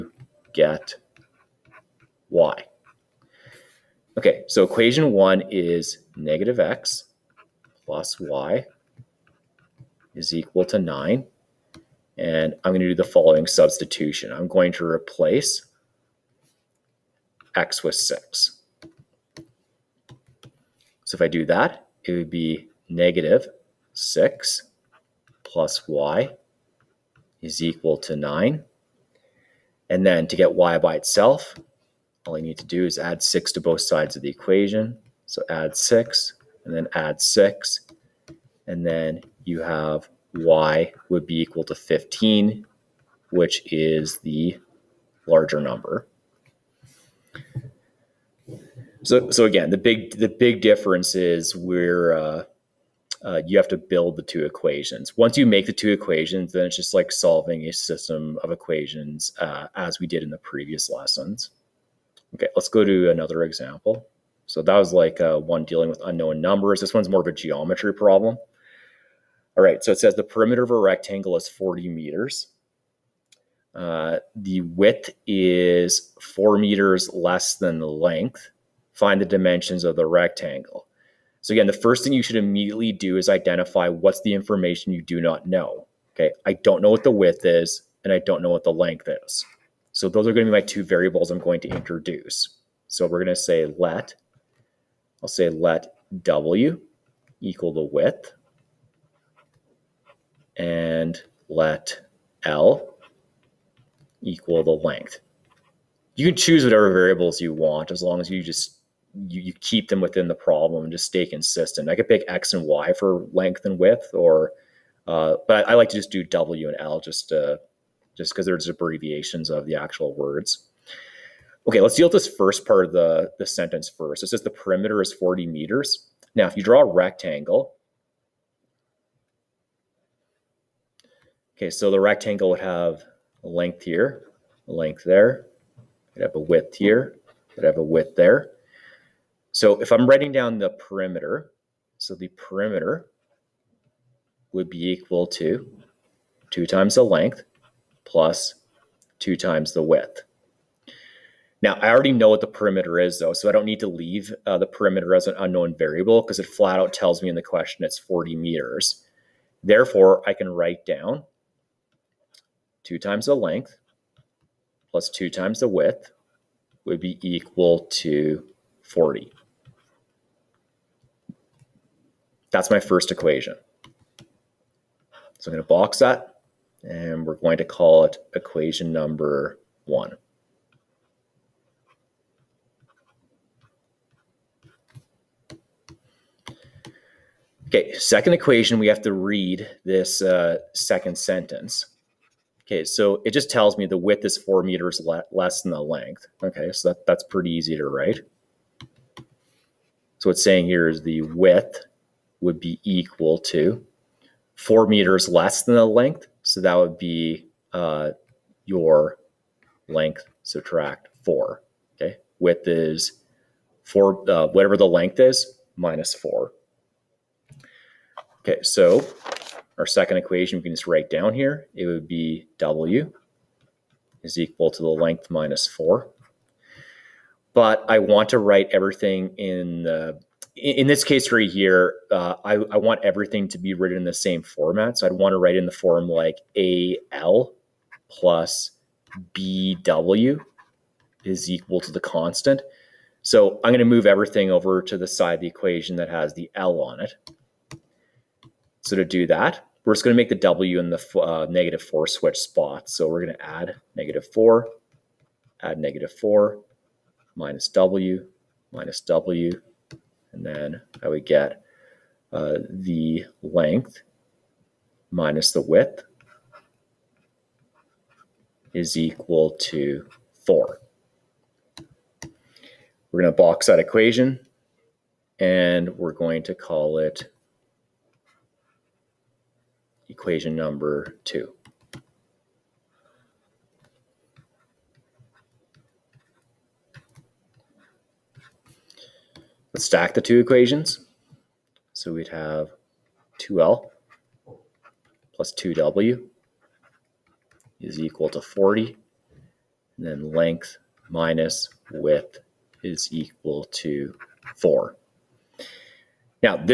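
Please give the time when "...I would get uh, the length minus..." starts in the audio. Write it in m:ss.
4:21.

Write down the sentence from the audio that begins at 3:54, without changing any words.
So I'd want to write in the form like AL plus BW is equal to the constant.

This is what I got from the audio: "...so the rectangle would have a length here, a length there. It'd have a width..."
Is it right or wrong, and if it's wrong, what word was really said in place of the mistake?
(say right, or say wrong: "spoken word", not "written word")
right.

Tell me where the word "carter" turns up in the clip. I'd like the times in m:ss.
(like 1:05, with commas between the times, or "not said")
not said.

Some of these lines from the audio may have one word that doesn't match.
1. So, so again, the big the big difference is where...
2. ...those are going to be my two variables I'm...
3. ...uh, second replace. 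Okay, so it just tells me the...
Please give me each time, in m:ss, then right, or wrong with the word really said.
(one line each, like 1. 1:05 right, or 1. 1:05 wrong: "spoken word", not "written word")
1. 0:49 right
2. 1:30 right
3. 3:10 wrong: "sentence", not "replace".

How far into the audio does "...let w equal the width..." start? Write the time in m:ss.
1:35.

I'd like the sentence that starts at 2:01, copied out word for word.
Okay, let's deal with this first part of the, the sentence first.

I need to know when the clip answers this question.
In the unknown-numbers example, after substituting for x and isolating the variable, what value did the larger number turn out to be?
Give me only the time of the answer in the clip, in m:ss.
0:41.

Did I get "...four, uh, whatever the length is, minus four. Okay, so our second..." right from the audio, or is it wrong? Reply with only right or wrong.
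right.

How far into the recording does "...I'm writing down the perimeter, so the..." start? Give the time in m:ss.
2:19.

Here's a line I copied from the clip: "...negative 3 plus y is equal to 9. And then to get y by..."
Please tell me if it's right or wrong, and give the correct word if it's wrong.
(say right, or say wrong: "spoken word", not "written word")
wrong: "6", not "3".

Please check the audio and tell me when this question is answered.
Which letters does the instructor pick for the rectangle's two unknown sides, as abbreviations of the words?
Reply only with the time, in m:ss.
1:56.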